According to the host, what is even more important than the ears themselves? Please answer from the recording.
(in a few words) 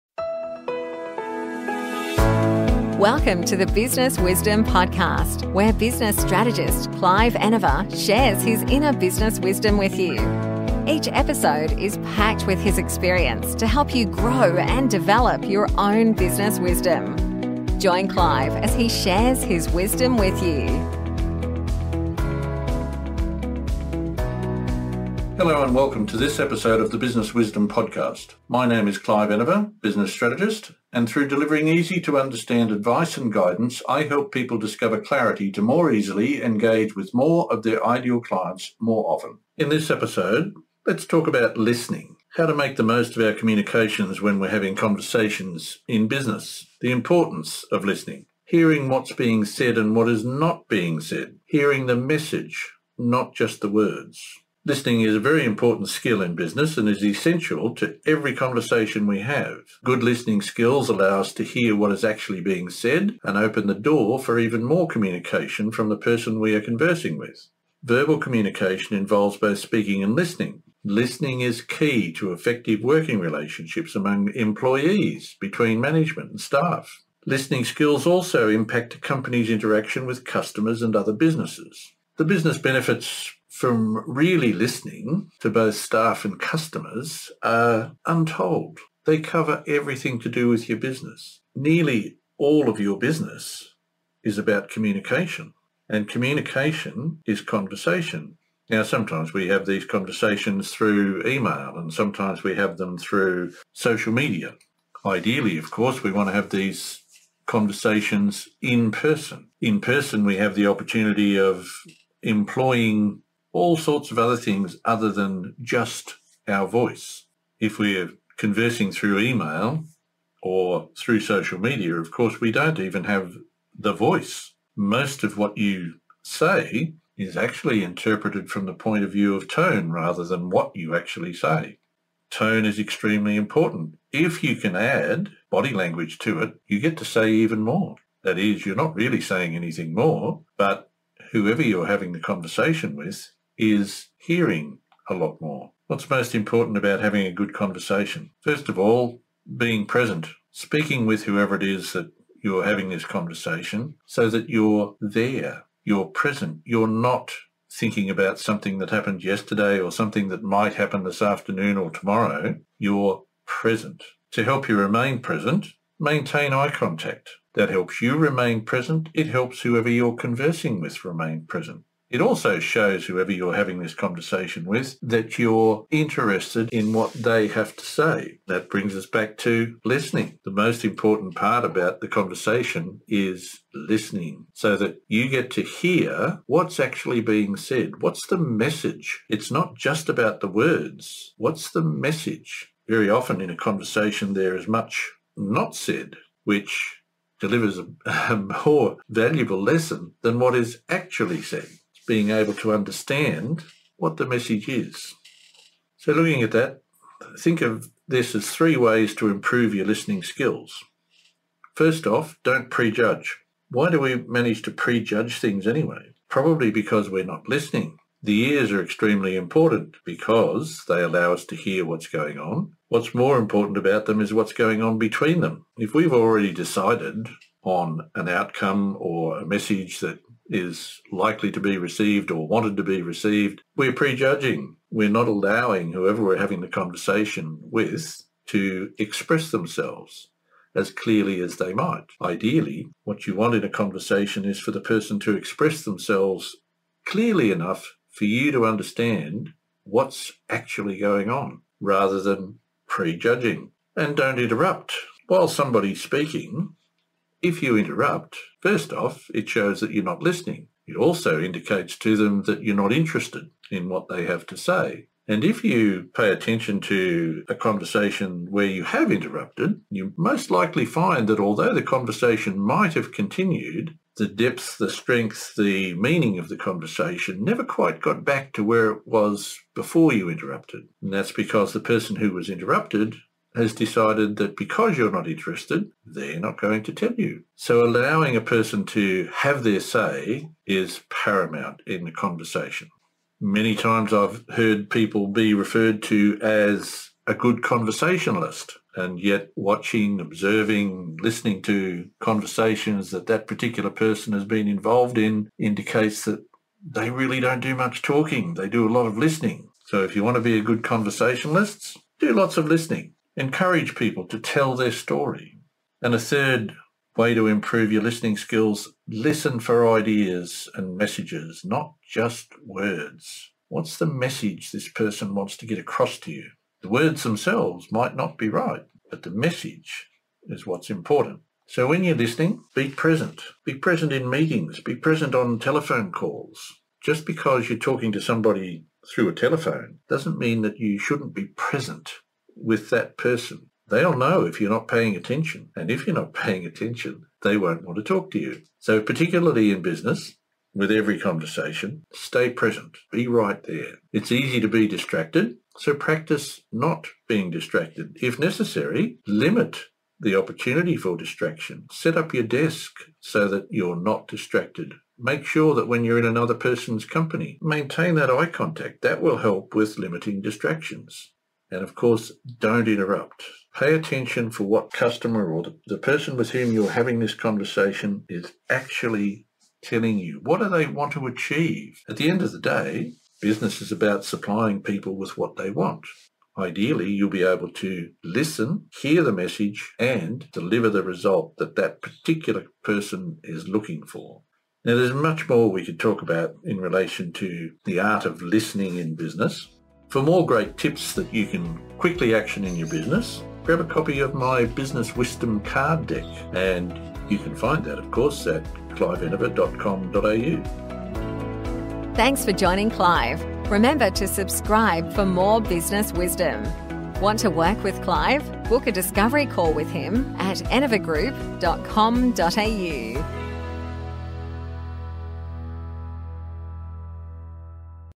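What's going on between them.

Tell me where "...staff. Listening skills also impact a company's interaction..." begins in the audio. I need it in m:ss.
1:16.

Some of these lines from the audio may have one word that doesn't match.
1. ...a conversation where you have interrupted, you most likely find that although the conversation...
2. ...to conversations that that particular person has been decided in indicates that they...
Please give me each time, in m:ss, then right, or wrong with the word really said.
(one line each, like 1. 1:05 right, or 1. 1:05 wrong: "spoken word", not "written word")
1. 4:27 right
2. 5:01 wrong: "involved", not "decided".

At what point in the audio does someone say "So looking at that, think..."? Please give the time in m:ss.
3:25.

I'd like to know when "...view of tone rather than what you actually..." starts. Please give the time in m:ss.
2:09.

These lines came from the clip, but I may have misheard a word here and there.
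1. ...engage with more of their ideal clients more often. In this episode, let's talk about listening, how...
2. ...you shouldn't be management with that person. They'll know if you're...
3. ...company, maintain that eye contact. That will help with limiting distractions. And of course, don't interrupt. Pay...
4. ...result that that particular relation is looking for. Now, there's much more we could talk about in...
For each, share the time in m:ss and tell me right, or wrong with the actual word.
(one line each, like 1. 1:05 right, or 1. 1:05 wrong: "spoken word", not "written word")
1. 0:36 right
2. 5:40 wrong: "present", not "management"
3. 6:07 right
4. 6:31 wrong: "person", not "relation".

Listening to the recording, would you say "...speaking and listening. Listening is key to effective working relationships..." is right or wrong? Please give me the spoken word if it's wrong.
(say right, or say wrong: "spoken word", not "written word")
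right.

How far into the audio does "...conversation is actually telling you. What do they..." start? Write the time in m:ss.
6:17.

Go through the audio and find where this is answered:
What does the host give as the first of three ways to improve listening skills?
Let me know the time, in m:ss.
3:32.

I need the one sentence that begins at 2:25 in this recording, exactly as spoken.
What's most important about having a good conversation?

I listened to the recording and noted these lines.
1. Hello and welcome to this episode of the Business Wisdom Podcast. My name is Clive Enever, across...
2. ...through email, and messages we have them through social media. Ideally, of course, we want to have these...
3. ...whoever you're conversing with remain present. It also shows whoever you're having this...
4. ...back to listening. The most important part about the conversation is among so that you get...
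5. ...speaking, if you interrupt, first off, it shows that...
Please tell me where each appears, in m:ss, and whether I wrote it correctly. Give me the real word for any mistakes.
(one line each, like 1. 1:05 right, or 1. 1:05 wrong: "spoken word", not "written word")
1. 0:25 wrong: "business", not "across"
2. 1:40 wrong: "sometimes", not "messages"
3. 2:49 right
4. 2:59 wrong: "listening", not "among"
5. 4:16 right.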